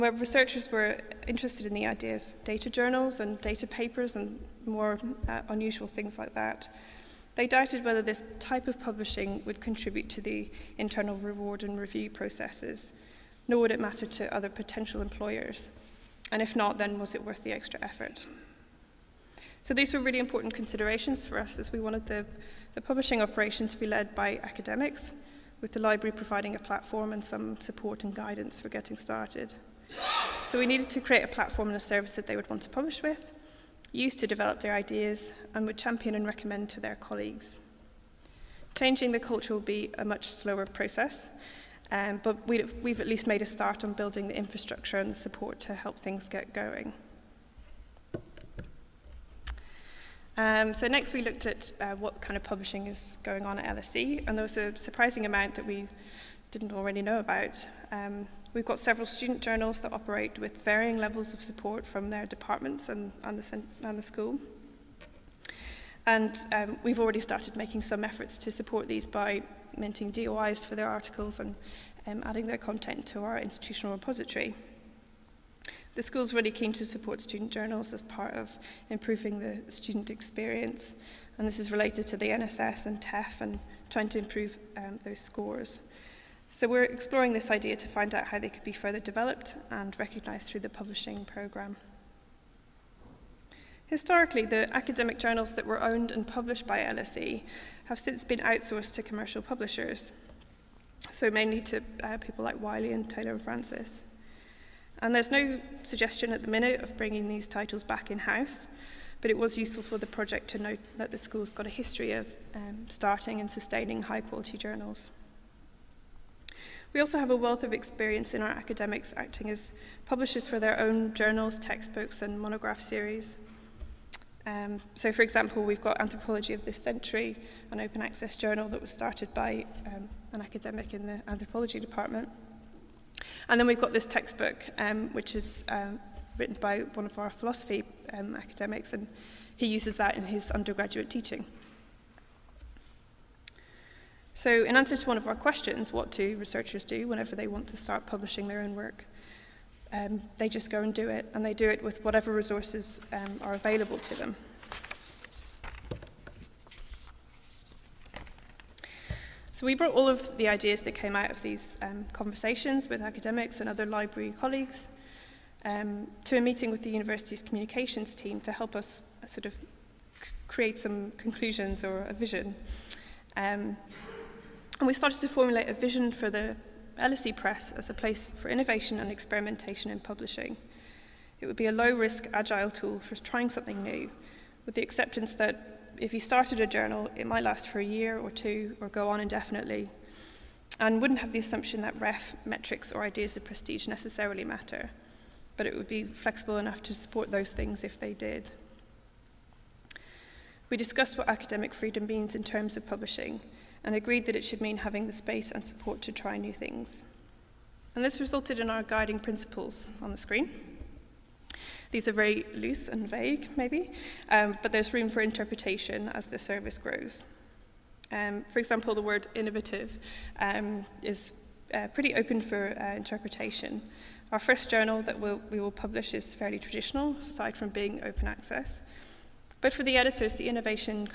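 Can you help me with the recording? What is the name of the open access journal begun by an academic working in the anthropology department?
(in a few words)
Anthropology of this Century.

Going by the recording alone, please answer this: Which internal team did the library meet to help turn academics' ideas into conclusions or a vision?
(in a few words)
communications team.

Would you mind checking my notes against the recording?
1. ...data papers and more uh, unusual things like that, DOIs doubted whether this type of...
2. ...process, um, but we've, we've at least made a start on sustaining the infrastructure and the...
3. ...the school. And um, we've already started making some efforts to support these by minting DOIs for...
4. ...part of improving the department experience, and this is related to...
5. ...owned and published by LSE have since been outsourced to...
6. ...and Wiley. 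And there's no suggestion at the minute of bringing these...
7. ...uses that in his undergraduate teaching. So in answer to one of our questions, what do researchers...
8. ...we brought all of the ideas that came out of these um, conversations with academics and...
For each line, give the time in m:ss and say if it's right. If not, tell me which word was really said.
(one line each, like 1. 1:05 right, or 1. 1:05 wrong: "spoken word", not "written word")
1. 0:03 wrong: "They", not "DOIs"
2. 0:40 wrong: "building", not "sustaining"
3. 1:03 right
4. 1:18 wrong: "student", not "department"
5. 1:35 right
6. 1:43 wrong: "Francis", not "Wiley"
7. 2:19 right
8. 2:39 right.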